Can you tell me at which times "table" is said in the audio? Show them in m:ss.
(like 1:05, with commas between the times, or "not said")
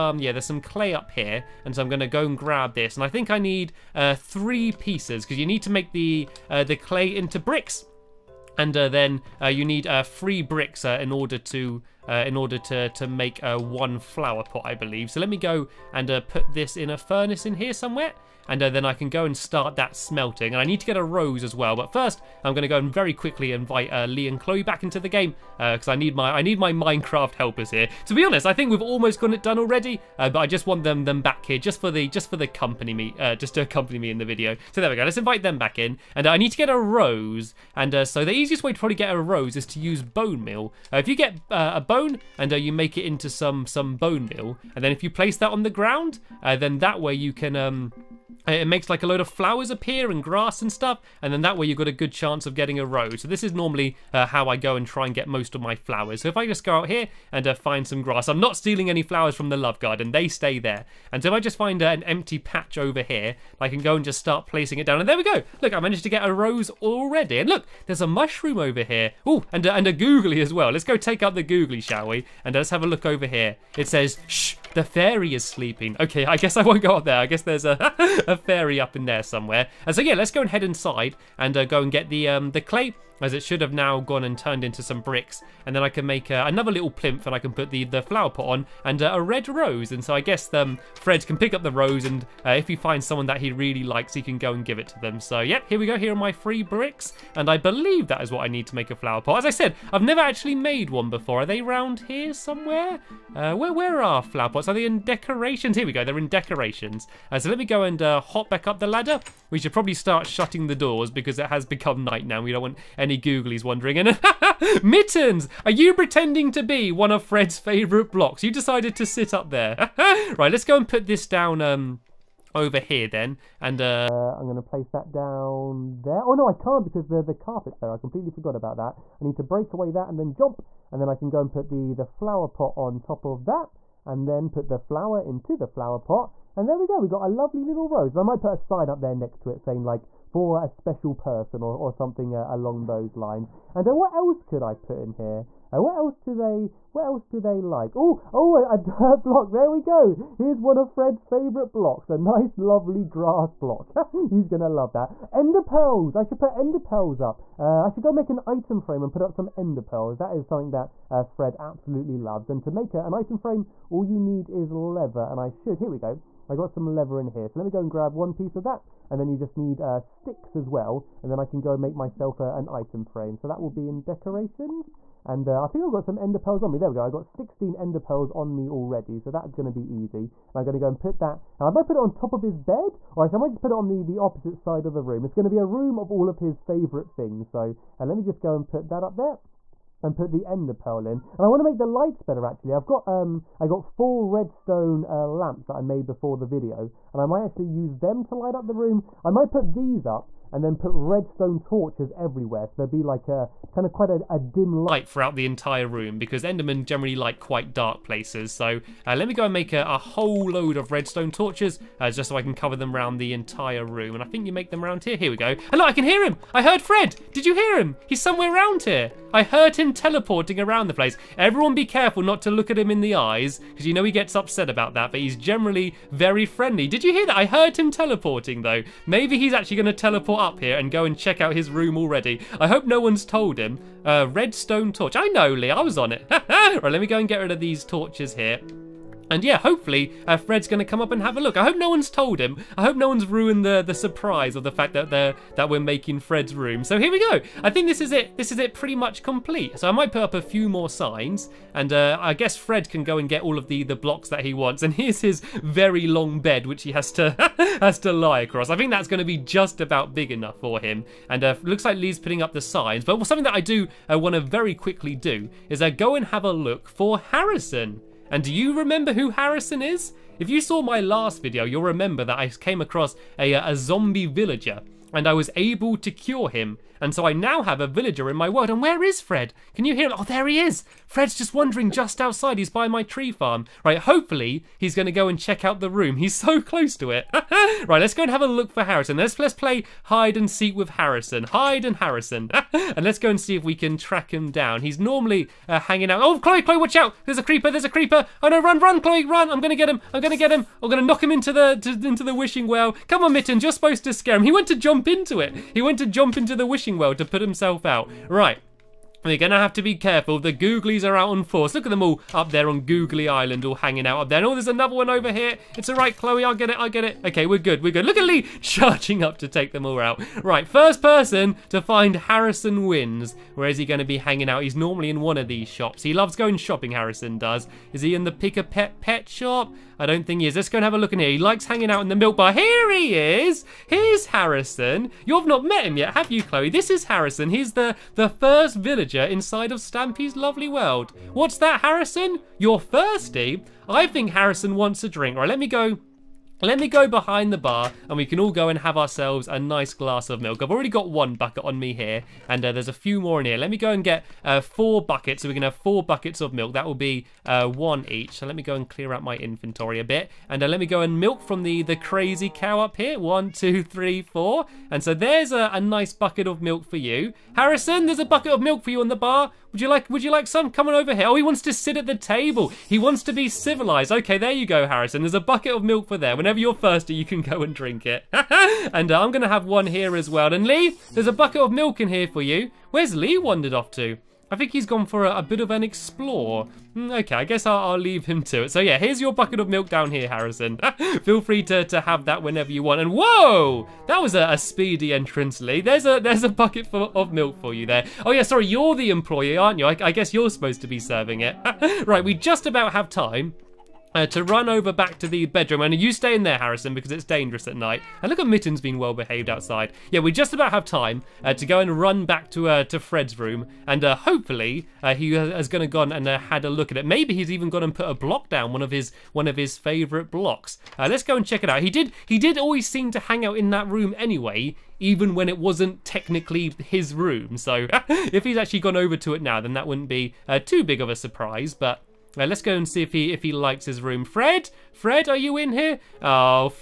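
6:12.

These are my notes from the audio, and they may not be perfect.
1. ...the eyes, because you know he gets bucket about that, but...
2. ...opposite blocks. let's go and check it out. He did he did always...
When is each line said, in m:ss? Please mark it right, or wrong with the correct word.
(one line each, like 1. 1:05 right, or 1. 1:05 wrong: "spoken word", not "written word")
1. 3:43 wrong: "upset", not "bucket"
2. 6:59 wrong: "favourite", not "opposite".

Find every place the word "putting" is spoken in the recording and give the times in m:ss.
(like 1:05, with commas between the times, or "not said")
4:22.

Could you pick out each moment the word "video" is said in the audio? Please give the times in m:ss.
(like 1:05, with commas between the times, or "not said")
0:34, 3:16, 4:31.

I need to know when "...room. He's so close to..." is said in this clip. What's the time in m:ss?
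4:45.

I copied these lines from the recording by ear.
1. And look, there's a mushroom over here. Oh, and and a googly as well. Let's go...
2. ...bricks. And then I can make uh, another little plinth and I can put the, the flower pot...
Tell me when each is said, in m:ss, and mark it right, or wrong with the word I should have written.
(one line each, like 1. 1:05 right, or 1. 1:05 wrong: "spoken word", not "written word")
1. 1:07 right
2. 1:25 right.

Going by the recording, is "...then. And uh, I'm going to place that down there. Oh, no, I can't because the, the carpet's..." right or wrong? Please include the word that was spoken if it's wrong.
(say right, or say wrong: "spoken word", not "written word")
right.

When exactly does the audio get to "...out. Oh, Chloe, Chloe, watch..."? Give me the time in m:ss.
4:56.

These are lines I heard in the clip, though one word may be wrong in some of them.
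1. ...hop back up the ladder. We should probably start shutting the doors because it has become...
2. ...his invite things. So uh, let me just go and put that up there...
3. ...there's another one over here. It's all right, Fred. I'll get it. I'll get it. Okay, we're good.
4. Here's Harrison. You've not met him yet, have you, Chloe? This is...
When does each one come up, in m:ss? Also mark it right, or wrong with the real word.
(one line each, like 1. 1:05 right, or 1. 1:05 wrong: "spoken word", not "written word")
1. 1:48 right
2. 3:06 wrong: "favourite", not "invite"
3. 5:14 wrong: "Chloe", not "Fred"
4. 5:33 right.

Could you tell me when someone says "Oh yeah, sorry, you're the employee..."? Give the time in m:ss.
6:38.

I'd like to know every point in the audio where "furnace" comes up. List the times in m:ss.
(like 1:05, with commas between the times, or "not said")
0:16.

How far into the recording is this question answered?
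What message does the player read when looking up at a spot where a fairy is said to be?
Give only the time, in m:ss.
1:14.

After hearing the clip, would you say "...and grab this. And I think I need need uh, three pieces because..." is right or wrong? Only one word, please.
right.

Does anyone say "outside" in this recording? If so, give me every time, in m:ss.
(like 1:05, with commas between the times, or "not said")
4:42, 6:49.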